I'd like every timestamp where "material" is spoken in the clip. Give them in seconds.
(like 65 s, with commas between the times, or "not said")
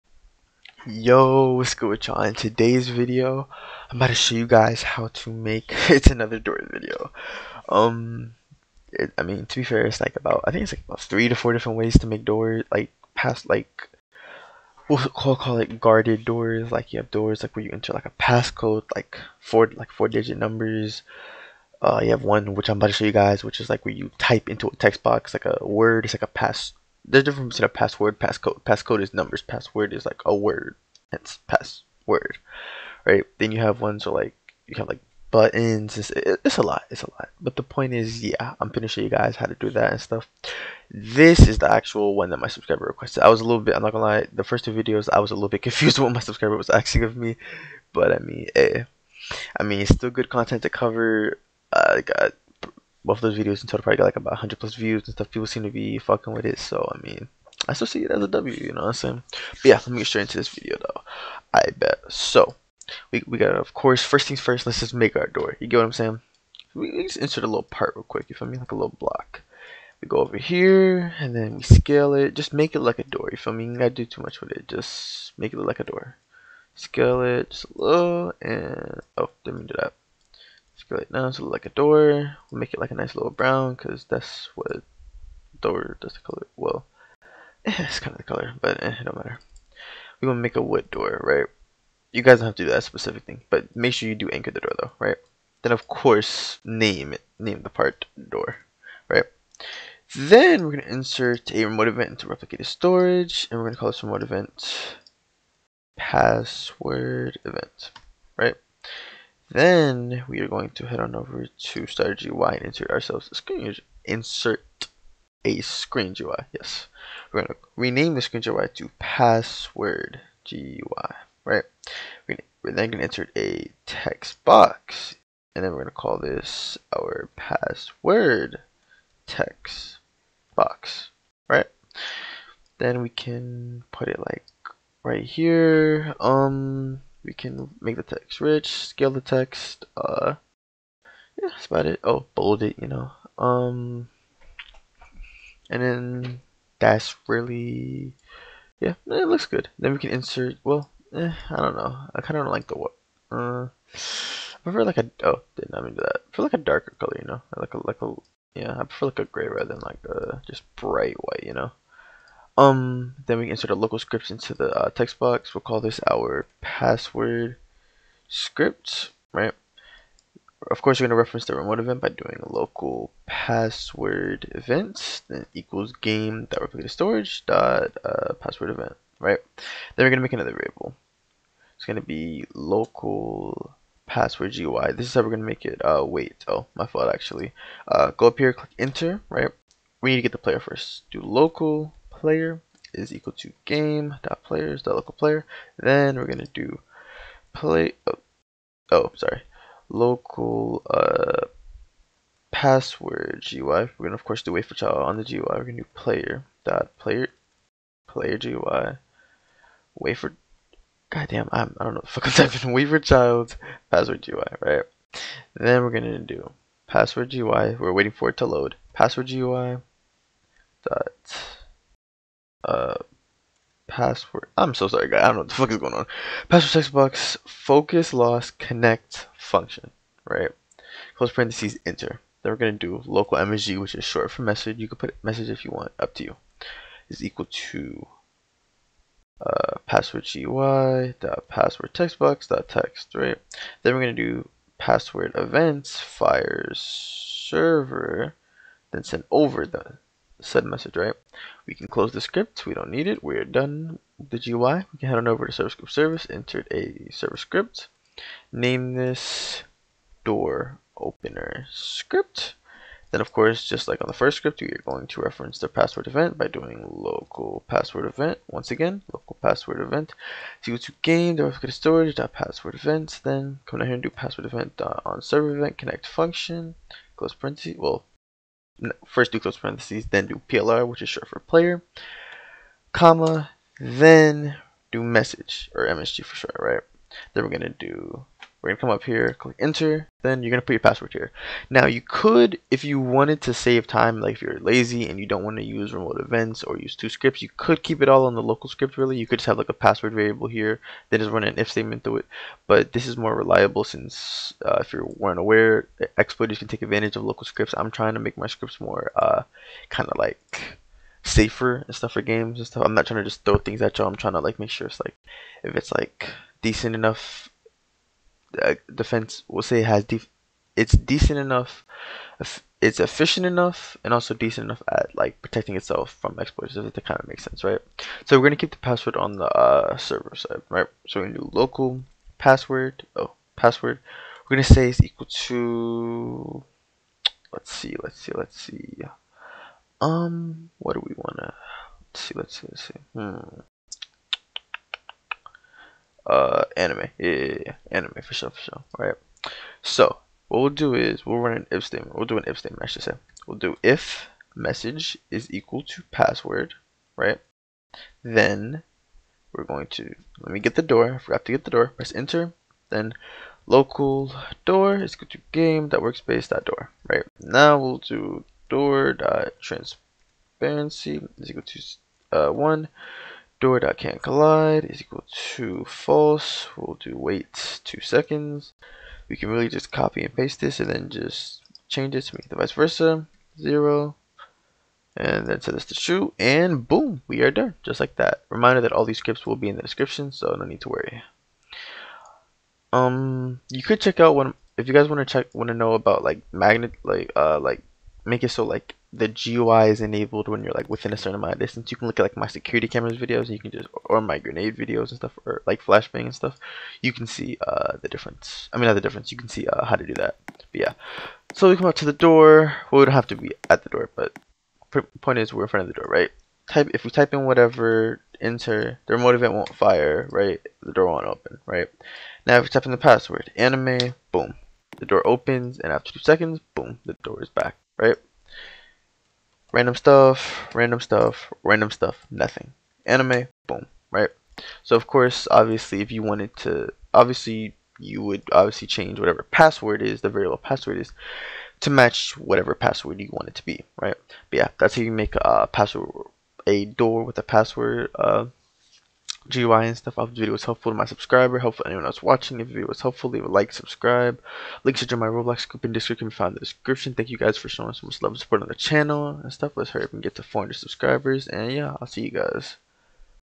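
not said.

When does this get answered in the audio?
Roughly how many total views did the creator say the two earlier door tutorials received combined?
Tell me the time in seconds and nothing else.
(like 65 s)
54 s.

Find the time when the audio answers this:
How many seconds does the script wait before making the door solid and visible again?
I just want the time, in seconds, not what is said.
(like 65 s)
377 s.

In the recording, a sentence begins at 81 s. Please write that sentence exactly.
So like a door, we'll make it like a nice little brown because that's what door does the color.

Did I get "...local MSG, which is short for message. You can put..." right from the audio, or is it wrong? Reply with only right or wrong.
right.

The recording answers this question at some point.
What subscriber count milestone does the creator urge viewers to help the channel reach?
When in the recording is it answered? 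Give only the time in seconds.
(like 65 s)
460 s.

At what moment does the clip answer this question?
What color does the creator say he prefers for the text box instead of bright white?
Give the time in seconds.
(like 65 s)
158 s.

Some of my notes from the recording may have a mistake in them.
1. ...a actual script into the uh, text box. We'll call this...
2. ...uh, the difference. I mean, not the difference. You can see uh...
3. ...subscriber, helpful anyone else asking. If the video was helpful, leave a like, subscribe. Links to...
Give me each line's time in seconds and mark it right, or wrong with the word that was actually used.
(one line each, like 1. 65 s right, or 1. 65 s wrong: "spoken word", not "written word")
1. 163 s wrong: "local", not "actual"
2. 407 s right
3. 451 s wrong: "watching", not "asking".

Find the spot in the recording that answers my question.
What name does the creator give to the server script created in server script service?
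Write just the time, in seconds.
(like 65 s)
258 s.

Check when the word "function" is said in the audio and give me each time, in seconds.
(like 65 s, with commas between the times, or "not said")
229 s, 276 s.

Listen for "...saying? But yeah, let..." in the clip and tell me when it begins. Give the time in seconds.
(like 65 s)
58 s.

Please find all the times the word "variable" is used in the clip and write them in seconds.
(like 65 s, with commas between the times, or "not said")
180 s, 300 s, 440 s.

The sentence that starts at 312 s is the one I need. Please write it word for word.
I'm not trying to just throw things at y'all.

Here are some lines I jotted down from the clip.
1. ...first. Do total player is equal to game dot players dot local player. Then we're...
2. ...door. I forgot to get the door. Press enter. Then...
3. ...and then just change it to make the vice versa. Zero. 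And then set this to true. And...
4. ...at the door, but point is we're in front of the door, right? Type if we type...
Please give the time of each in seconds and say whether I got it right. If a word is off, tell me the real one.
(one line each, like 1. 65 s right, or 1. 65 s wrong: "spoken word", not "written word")
1. 190 s wrong: "local", not "total"
2. 360 s right
3. 380 s right
4. 413 s right.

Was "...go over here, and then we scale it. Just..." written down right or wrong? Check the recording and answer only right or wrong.
right.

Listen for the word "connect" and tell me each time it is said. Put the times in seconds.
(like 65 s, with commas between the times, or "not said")
228 s, 275 s.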